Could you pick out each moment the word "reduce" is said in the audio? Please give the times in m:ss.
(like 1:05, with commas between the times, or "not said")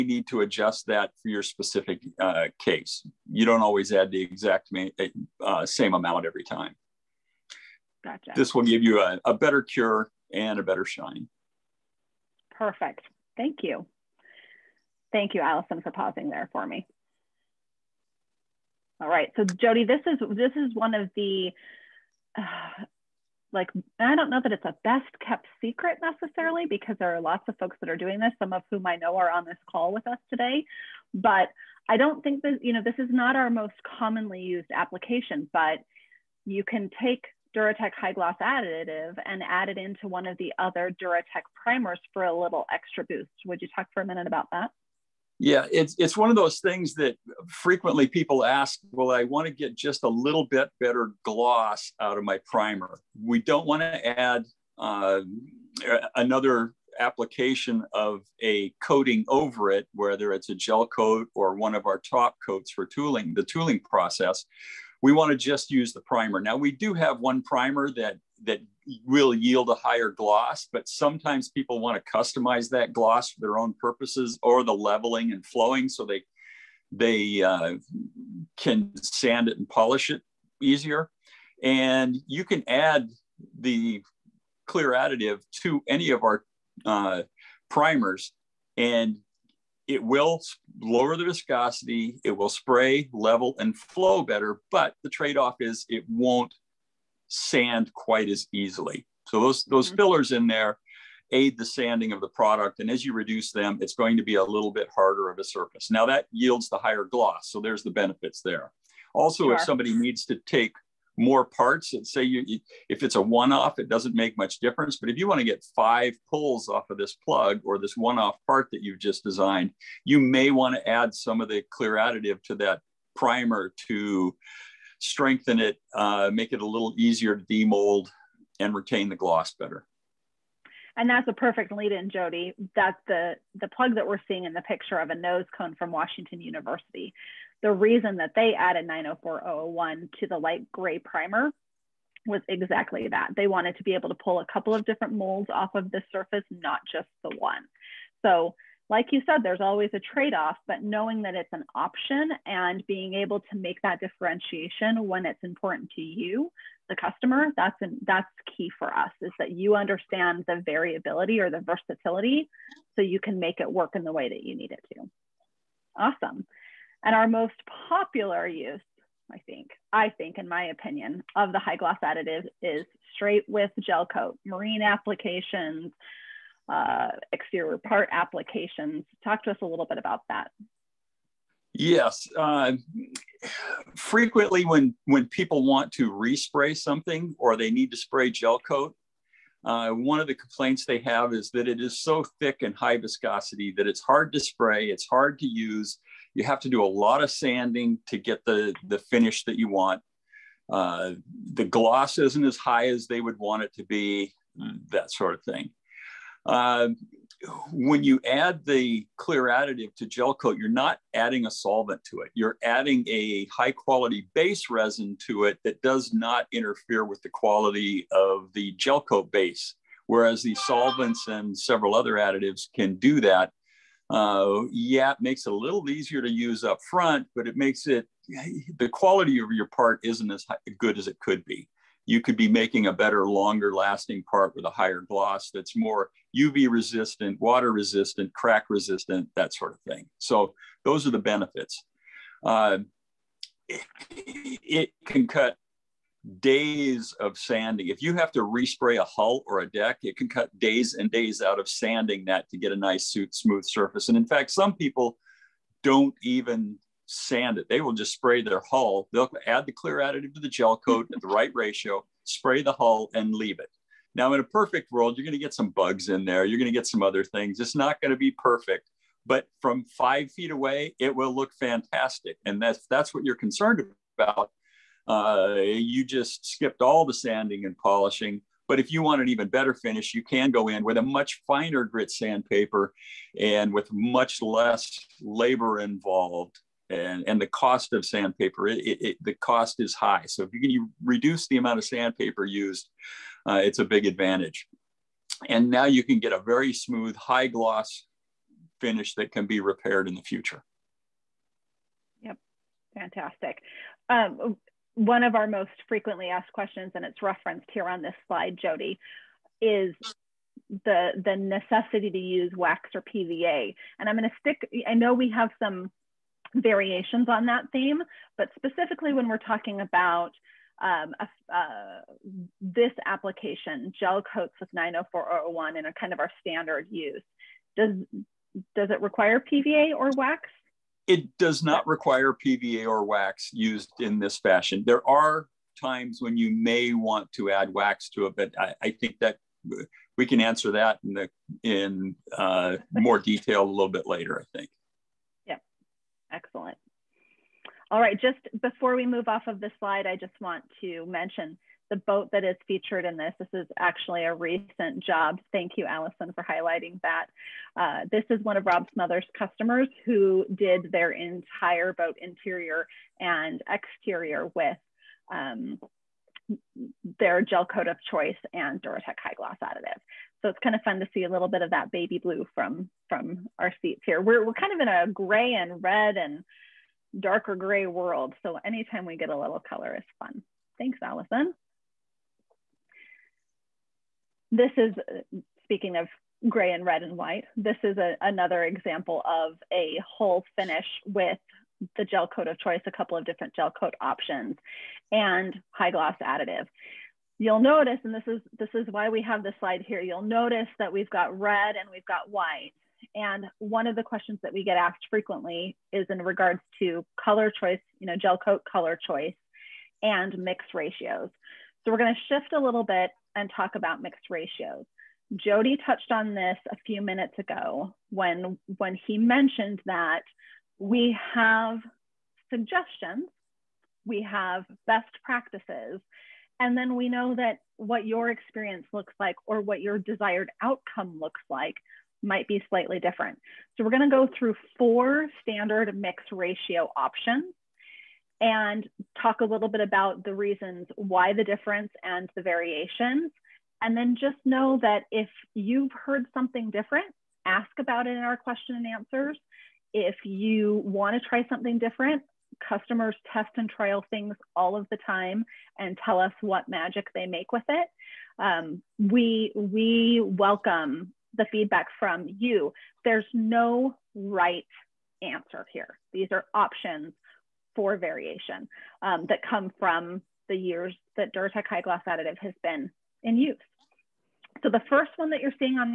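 1:43, 4:51.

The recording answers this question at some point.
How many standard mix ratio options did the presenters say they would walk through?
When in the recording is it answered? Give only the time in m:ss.
7:14.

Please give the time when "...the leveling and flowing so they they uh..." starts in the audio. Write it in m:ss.
1:14.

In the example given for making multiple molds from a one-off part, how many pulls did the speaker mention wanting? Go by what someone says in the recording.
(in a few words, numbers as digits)
5.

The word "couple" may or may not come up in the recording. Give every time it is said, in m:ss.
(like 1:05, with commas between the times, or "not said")
2:24, 6:32.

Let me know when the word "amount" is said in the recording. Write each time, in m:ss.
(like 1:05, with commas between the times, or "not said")
0:05, 4:51.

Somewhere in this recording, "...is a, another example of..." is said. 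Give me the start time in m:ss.
6:27.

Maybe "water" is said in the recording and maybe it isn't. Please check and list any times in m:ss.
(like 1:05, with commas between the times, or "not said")
3:57.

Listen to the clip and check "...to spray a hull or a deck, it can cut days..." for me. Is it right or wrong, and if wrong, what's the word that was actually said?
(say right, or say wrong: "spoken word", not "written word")
wrong: "respray", not "spray".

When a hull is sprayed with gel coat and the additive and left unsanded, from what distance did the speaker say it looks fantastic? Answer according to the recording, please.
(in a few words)
5 feet.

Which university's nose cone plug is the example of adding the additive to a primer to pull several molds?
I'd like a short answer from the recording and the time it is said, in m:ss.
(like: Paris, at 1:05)
Washington University, at 2:15.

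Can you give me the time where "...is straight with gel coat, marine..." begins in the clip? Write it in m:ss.
2:52.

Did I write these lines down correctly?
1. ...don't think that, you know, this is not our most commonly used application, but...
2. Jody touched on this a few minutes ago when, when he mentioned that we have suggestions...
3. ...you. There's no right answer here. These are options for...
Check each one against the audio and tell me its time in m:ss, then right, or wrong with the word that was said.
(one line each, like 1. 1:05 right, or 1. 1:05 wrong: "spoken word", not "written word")
1. 0:31 right
2. 6:55 right
3. 7:42 right.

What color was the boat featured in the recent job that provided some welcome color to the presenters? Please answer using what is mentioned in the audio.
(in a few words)
baby blue.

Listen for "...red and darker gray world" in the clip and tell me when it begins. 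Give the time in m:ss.
6:15.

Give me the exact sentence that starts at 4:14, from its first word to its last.
And in fact, some people don't even sand it.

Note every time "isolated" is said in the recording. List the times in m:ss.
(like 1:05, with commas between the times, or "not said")
not said.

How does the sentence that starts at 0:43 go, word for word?
Would you talk for a minute about that?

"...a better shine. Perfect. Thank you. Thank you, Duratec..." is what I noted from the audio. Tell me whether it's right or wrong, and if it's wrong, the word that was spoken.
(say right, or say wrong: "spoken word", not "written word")
wrong: "Allison", not "Duratec".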